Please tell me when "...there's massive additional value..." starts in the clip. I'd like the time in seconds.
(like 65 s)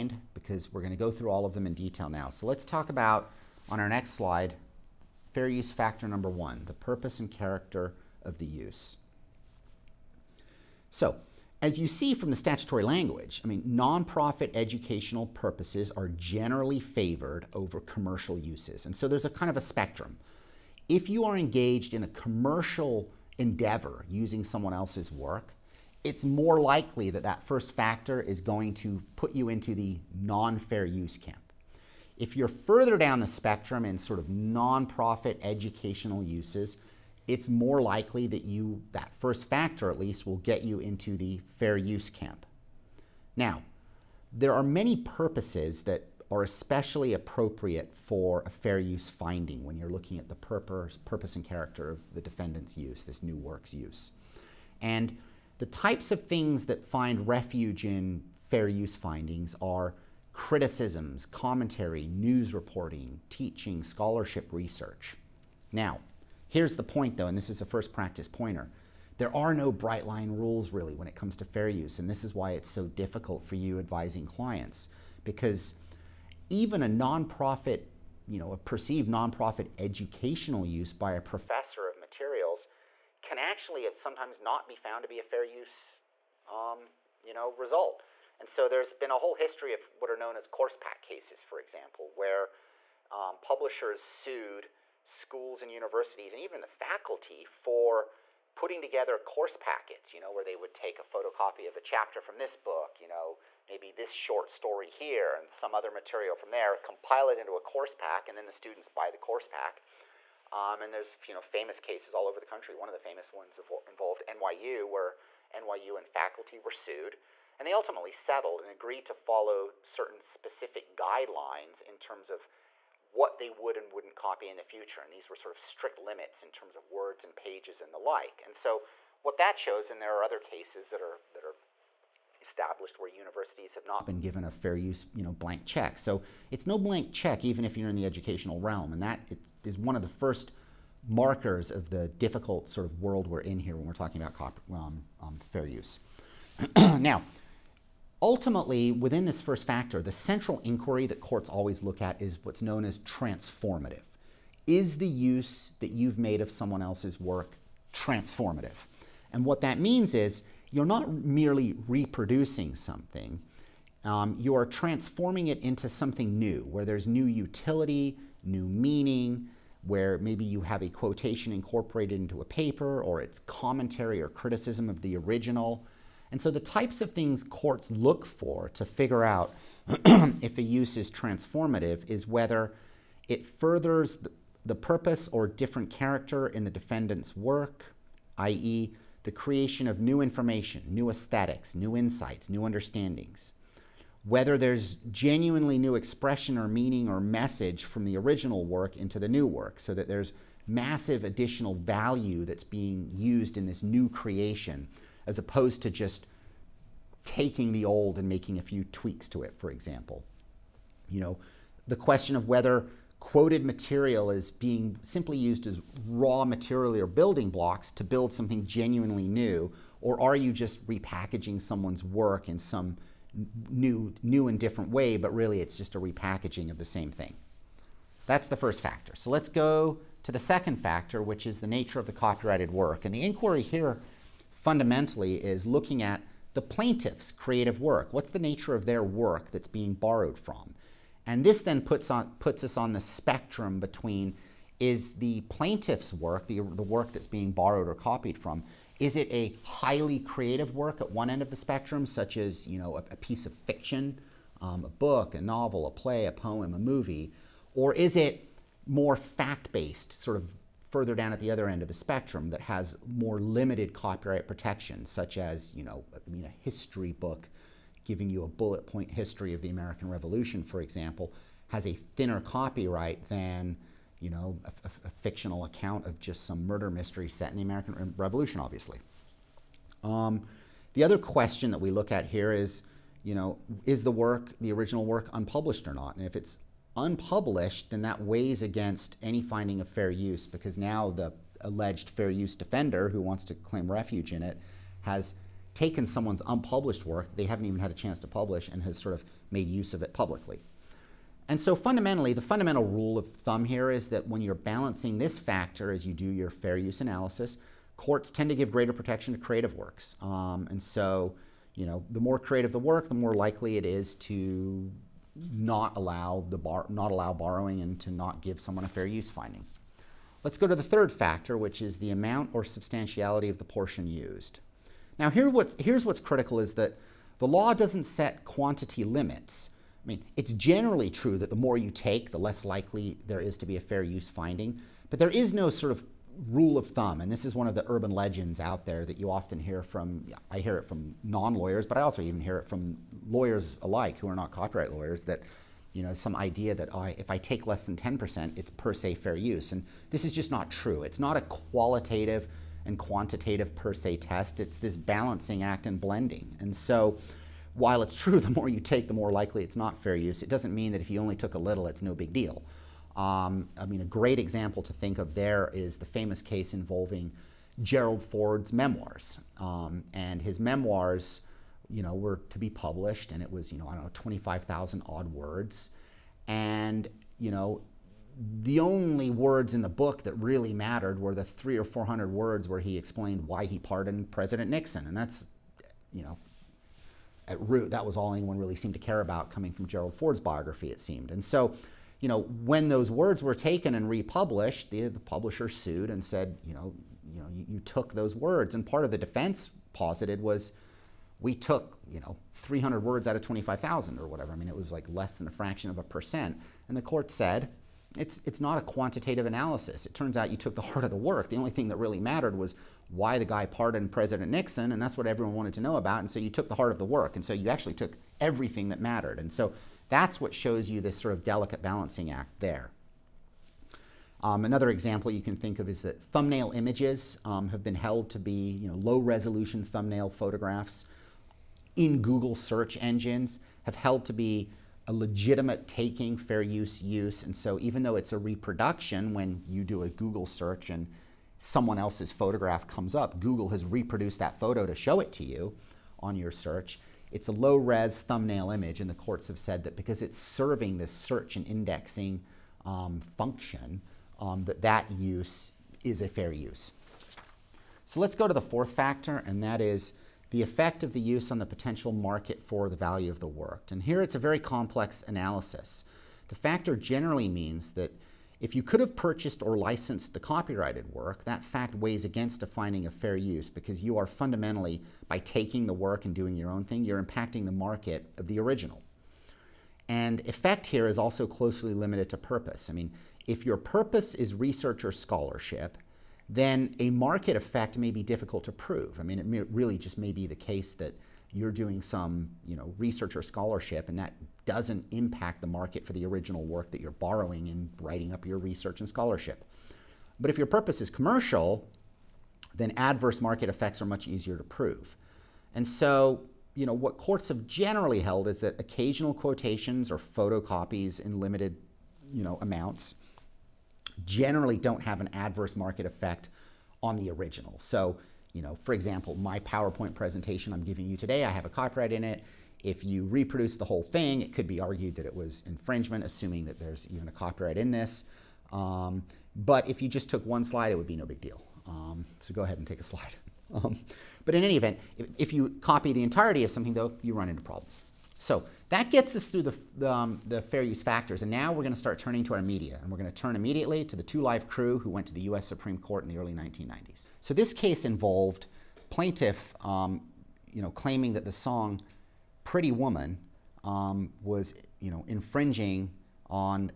200 s.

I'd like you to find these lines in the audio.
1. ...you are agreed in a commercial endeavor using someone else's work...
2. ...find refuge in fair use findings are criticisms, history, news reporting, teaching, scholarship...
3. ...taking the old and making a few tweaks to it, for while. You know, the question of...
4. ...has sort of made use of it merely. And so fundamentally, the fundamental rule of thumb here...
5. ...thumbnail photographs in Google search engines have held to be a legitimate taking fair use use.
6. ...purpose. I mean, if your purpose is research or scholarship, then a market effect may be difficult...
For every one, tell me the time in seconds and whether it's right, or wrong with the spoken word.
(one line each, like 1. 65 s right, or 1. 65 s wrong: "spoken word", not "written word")
1. 21 s wrong: "engaged", not "agreed"
2. 56 s wrong: "commentary", not "history"
3. 207 s wrong: "example", not "while"
4. 298 s wrong: "publicly", not "merely"
5. 429 s right
6. 482 s right.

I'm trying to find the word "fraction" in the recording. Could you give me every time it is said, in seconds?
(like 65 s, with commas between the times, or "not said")
405 s.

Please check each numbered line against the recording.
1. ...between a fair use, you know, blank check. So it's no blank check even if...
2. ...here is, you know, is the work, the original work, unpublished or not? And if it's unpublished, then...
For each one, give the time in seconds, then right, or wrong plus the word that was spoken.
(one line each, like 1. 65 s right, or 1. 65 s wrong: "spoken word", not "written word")
1. 134 s wrong: "given", not "between"
2. 282 s right.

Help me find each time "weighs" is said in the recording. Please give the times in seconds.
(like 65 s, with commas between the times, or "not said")
288 s, 471 s.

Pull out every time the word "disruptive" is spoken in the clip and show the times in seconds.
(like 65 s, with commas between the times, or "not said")
not said.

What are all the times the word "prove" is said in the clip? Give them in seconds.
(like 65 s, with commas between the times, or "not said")
488 s, 504 s.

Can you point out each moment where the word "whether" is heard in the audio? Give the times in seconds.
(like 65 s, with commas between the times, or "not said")
182 s, 194 s, 212 s.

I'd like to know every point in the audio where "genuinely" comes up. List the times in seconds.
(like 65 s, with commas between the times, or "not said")
195 s, 218 s.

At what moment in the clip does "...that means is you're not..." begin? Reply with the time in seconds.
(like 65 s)
159 s.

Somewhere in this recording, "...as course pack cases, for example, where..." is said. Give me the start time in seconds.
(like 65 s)
90 s.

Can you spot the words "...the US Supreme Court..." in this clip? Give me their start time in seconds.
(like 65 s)
545 s.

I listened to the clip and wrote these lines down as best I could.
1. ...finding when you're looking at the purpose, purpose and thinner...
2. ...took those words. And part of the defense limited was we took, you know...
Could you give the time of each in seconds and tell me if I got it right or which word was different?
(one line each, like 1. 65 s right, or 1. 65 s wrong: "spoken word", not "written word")
1. 49 s wrong: "character", not "thinner"
2. 397 s wrong: "posited", not "limited".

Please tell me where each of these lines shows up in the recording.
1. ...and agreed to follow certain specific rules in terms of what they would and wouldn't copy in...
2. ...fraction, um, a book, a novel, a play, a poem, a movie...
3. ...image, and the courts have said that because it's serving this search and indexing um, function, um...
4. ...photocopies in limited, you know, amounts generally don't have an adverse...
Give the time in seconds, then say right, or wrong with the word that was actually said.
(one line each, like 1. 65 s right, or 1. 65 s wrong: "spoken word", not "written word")
1. 118 s wrong: "guidelines", not "rules"
2. 253 s wrong: "fiction", not "fraction"
3. 448 s right
4. 510 s right.